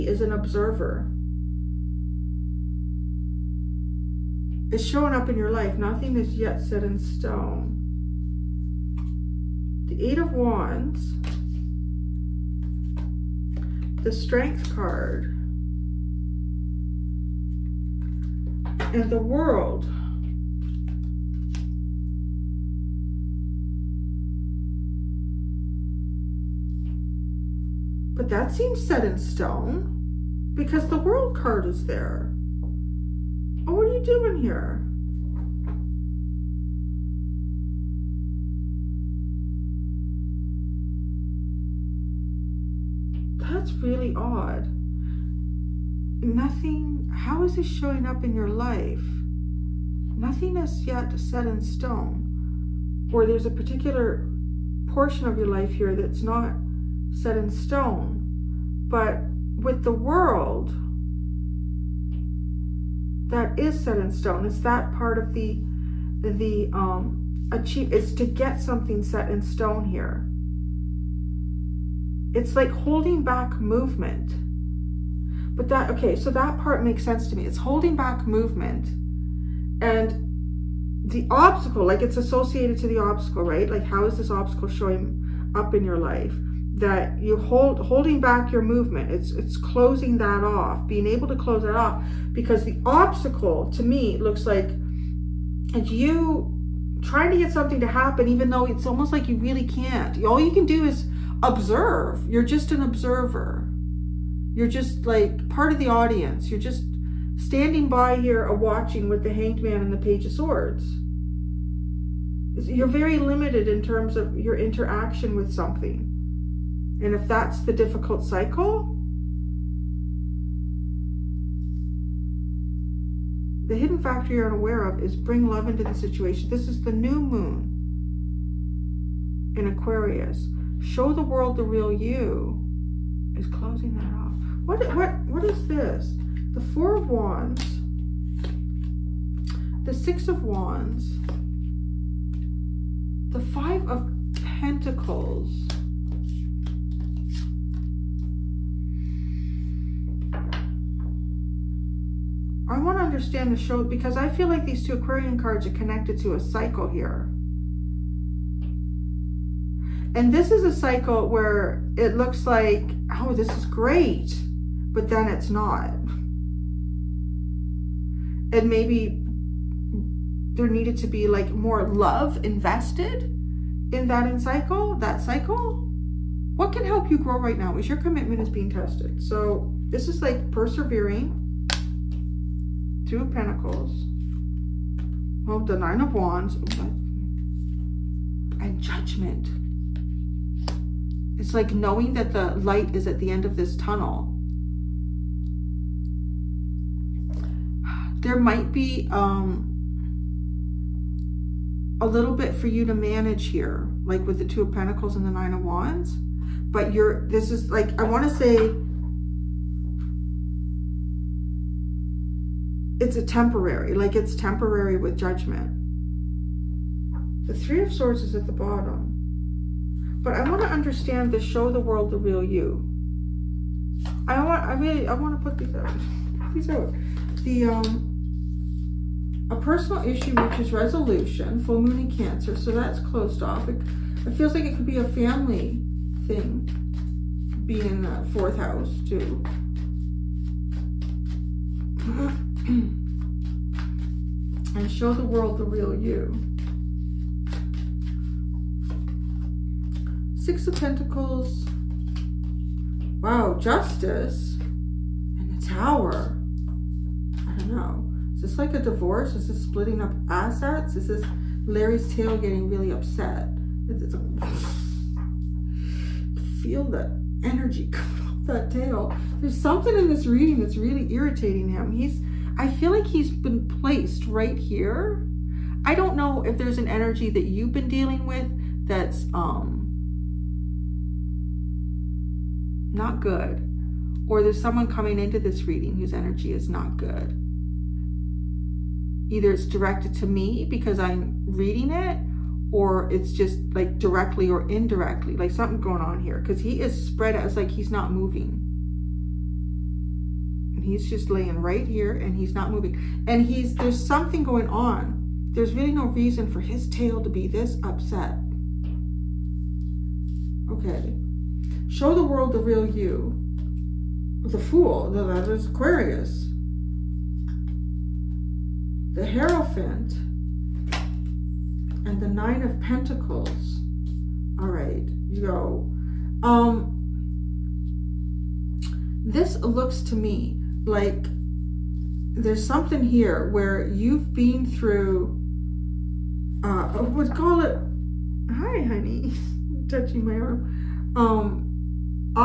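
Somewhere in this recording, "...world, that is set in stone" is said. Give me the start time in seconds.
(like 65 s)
59 s.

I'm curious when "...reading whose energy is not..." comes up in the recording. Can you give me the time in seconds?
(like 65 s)
285 s.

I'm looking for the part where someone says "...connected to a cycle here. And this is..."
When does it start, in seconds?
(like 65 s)
155 s.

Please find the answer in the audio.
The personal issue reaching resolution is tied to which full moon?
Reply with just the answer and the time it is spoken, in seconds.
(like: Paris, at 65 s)
Full moon in Cancer, at 231 s.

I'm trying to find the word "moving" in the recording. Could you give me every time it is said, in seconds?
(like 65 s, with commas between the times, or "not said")
298 s, 302 s.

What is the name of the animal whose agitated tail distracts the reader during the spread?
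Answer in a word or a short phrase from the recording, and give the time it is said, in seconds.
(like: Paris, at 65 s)
Larry, at 261 s.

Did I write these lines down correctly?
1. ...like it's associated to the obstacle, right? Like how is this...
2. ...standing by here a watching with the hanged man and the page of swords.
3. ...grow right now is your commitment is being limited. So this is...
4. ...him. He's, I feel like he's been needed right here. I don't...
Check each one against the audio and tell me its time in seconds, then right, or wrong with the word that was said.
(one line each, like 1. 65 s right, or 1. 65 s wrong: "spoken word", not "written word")
1. 81 s right
2. 107 s right
3. 177 s wrong: "tested", not "limited"
4. 271 s wrong: "placed", not "needed".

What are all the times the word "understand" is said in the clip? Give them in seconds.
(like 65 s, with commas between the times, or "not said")
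153 s, 220 s.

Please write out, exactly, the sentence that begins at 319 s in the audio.
The Hierophant and the Nine of Pentacles.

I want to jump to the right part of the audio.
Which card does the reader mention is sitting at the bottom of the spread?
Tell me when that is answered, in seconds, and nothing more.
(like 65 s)
217 s.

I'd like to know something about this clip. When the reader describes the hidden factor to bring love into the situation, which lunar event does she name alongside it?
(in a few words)
New moon in Aquarius.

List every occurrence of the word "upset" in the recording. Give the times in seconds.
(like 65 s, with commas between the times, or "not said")
262 s, 307 s.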